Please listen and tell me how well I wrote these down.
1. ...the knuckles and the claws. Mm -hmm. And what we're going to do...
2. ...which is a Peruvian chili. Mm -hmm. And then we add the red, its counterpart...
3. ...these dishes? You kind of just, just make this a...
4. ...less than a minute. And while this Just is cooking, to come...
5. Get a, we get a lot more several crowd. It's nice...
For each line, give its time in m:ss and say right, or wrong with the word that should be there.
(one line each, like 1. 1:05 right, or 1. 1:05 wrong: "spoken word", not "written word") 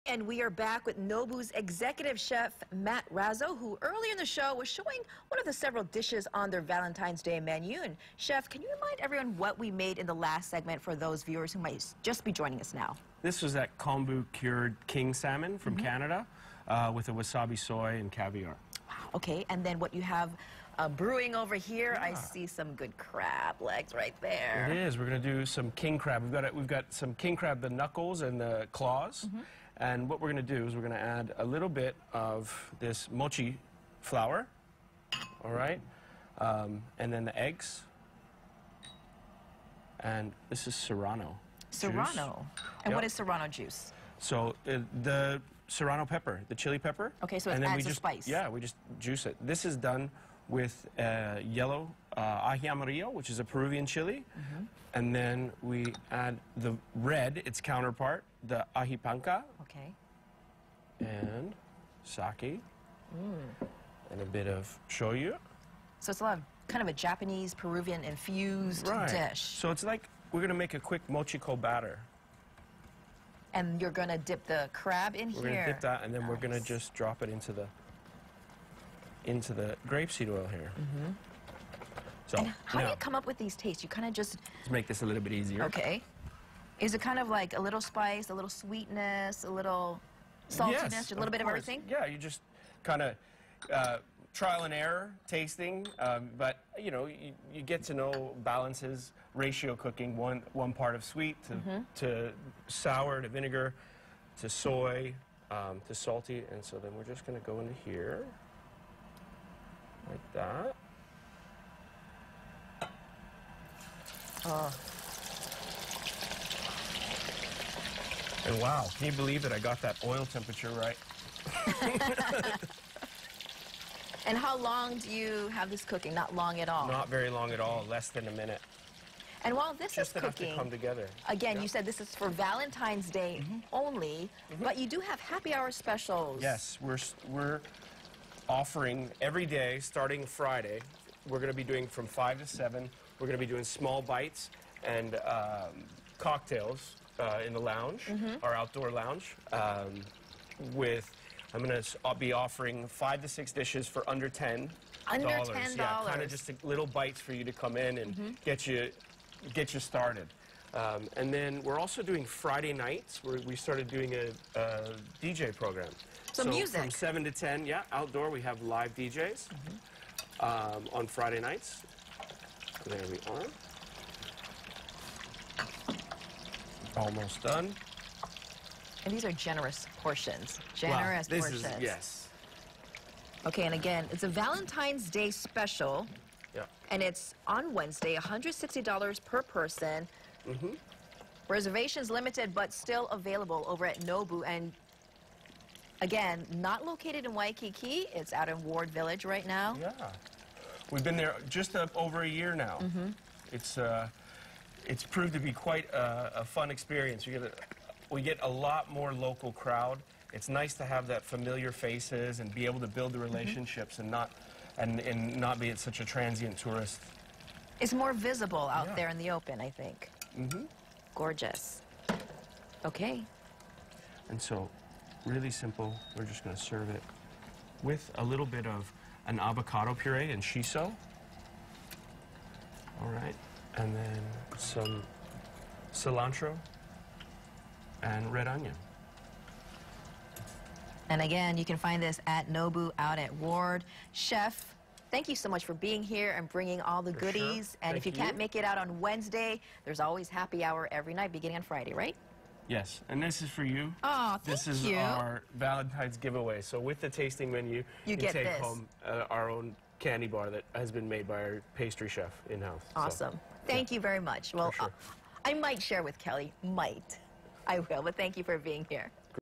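1. 0:27 right
2. 0:53 right
3. 1:23 wrong: "tastes", not "dishes"
4. 2:07 right
5. 3:27 wrong: "local", not "several".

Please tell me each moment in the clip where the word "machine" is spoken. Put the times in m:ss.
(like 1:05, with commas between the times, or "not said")
not said.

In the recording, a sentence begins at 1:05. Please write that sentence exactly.
So it's a lot of kind of a Japanese Peruvian infused right.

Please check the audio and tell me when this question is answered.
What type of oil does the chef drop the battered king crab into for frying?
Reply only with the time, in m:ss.
1:19.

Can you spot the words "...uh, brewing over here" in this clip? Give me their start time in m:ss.
0:20.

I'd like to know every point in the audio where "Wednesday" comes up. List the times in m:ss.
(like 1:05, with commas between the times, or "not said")
3:07, 4:08.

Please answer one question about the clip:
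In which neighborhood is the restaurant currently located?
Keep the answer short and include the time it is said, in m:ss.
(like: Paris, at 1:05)
Ward Village, at 3:18.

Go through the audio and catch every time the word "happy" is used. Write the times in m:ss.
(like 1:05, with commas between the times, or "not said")
2:15, 4:10.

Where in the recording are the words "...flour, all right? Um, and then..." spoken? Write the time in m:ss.
0:34.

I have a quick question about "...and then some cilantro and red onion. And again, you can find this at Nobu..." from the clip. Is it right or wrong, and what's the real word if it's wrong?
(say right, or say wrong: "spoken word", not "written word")
right.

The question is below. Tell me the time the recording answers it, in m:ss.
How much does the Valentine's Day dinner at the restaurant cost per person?
3:08.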